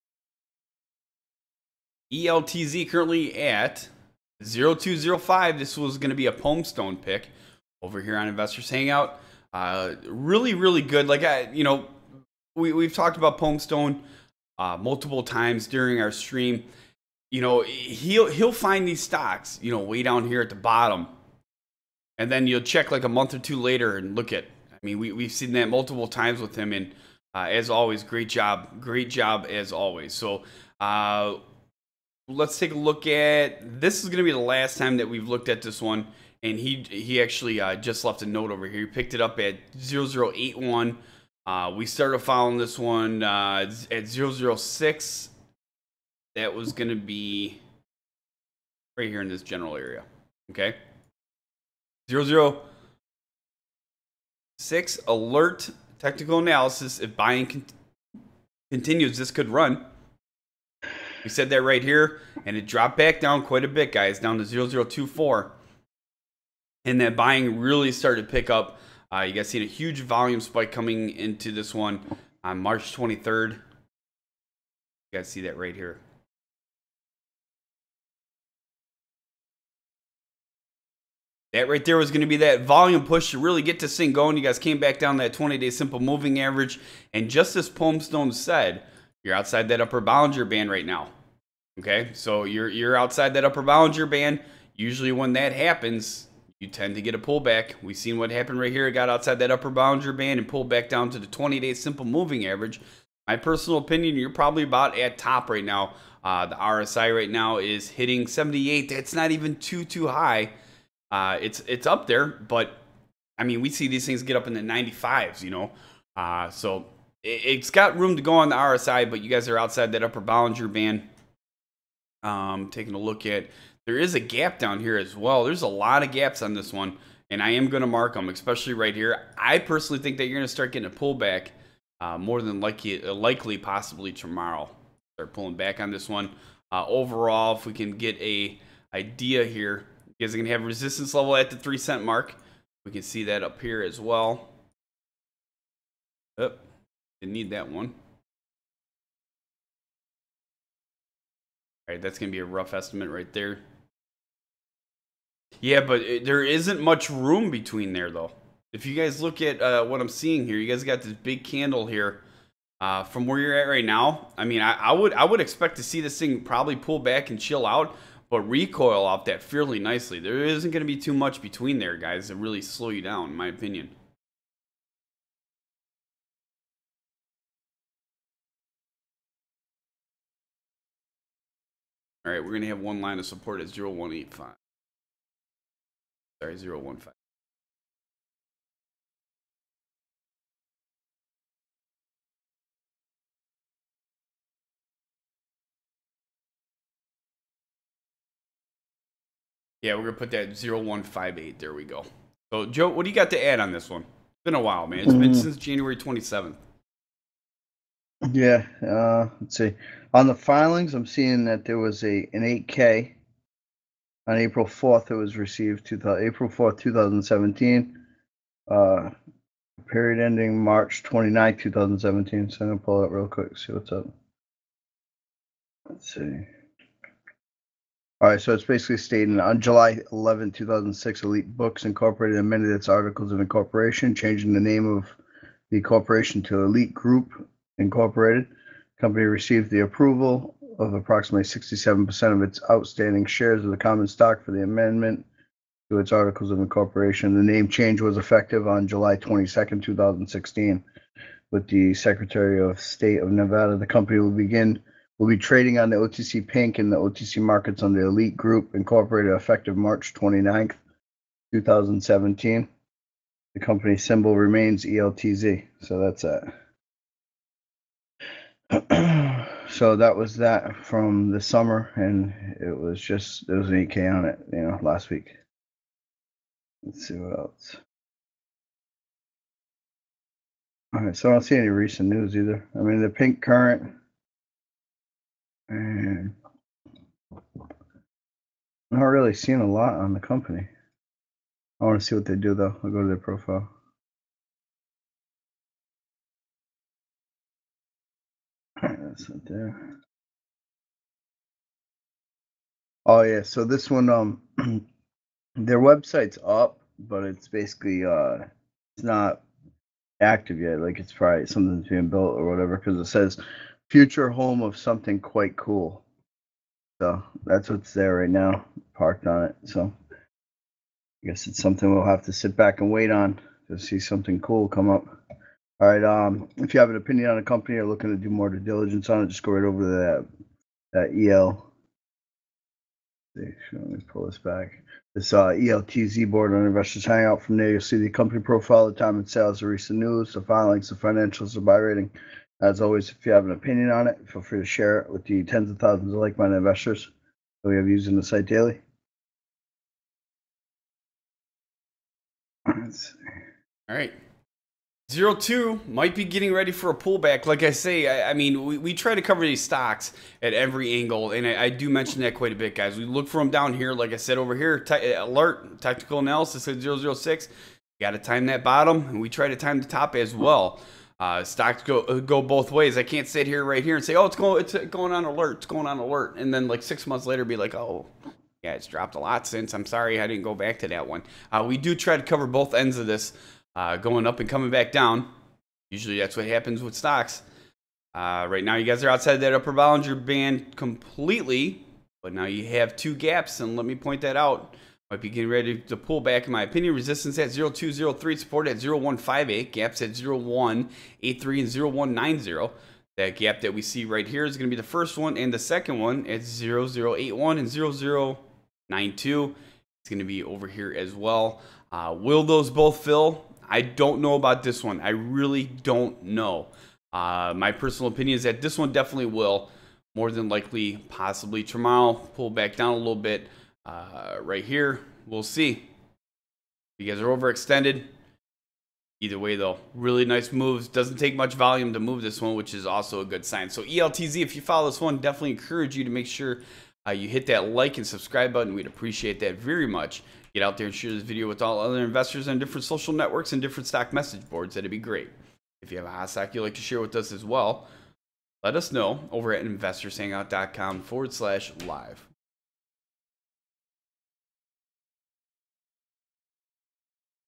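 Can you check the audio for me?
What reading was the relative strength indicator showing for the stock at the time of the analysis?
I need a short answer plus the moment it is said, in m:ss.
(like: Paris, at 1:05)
78, at 1:48.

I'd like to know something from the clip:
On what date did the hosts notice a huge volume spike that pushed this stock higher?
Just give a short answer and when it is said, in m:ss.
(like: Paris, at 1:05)
March 23rd, at 1:12.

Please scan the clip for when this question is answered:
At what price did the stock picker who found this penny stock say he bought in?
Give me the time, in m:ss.
0:38.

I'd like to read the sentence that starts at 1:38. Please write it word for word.
It got outside that upper Bollinger Band and pulled back down to the 20-day simple moving average.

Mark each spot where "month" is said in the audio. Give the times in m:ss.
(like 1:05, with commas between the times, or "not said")
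0:23, 6:17.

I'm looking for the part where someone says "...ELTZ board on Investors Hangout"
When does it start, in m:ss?
5:35.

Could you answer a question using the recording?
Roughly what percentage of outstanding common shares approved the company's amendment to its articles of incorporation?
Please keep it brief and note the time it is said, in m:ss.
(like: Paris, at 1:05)
67%, at 4:01.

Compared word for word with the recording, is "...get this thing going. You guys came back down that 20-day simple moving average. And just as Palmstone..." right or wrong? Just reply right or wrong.
right.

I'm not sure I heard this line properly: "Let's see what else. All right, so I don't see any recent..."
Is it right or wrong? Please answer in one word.
right.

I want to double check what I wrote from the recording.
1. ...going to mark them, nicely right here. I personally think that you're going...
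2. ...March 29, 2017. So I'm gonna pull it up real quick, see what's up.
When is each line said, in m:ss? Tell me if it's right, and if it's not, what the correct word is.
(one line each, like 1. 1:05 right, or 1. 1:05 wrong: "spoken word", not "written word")
1. 2:07 wrong: "especially", not "nicely"
2. 3:40 right.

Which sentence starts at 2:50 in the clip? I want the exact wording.
There isn't going to be too much between there, guys, to really slow you down, in my opinion.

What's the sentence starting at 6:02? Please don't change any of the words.
We look for them down here, like I said over here.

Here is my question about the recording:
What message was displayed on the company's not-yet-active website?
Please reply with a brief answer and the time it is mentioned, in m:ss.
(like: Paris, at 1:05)
Future home of something quite cool, at 5:13.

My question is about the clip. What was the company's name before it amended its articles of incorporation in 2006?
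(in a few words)
Elite Books Incorporated.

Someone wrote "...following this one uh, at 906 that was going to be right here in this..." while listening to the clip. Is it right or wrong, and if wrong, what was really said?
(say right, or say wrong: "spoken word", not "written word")
wrong: "006", not "906".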